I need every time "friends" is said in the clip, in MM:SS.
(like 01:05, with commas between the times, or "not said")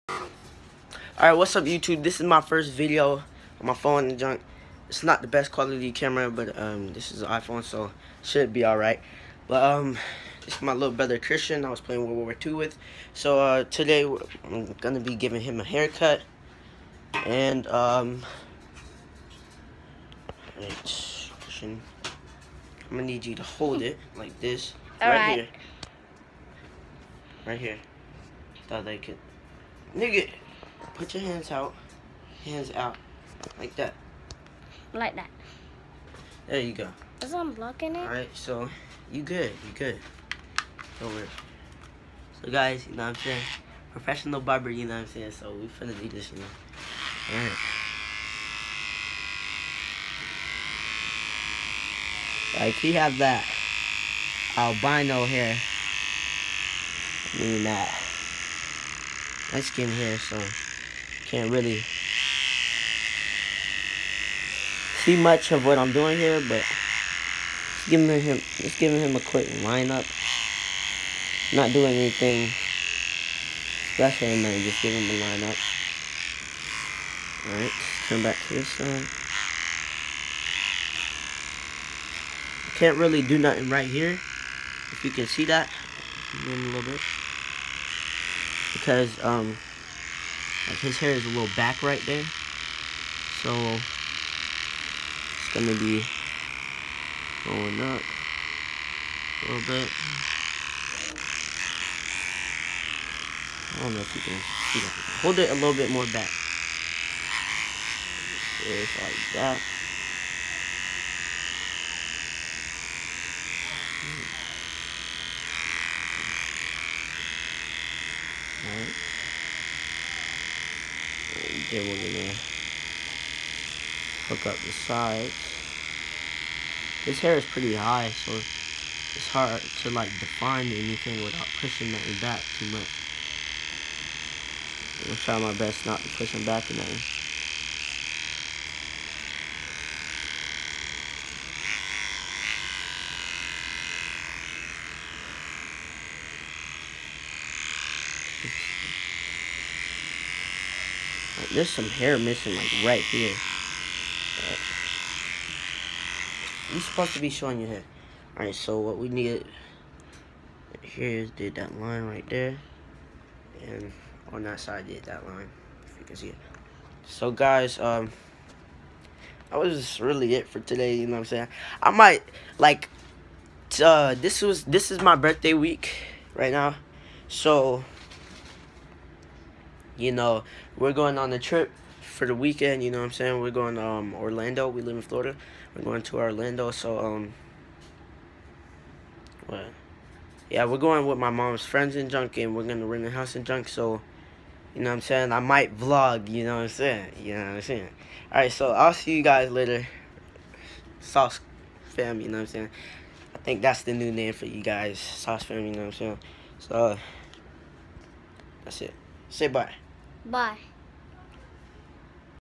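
03:11.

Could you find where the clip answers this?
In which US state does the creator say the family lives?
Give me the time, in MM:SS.
03:05.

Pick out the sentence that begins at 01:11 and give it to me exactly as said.
Not doing anything special and just giving him a lineup.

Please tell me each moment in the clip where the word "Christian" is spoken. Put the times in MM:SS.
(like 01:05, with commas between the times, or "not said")
00:11, 00:21.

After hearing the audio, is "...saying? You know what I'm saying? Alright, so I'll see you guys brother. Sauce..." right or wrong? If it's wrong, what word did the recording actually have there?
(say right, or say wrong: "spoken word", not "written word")
wrong: "later", not "brother".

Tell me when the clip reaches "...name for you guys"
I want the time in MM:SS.
03:24.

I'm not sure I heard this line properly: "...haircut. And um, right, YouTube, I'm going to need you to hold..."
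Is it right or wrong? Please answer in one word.
wrong.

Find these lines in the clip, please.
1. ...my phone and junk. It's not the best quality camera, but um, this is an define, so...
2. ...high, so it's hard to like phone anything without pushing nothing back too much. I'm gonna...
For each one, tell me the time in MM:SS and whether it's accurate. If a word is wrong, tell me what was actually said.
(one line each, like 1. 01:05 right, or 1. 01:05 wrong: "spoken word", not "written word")
1. 00:03 wrong: "iPhone", not "define"
2. 02:07 wrong: "define", not "phone".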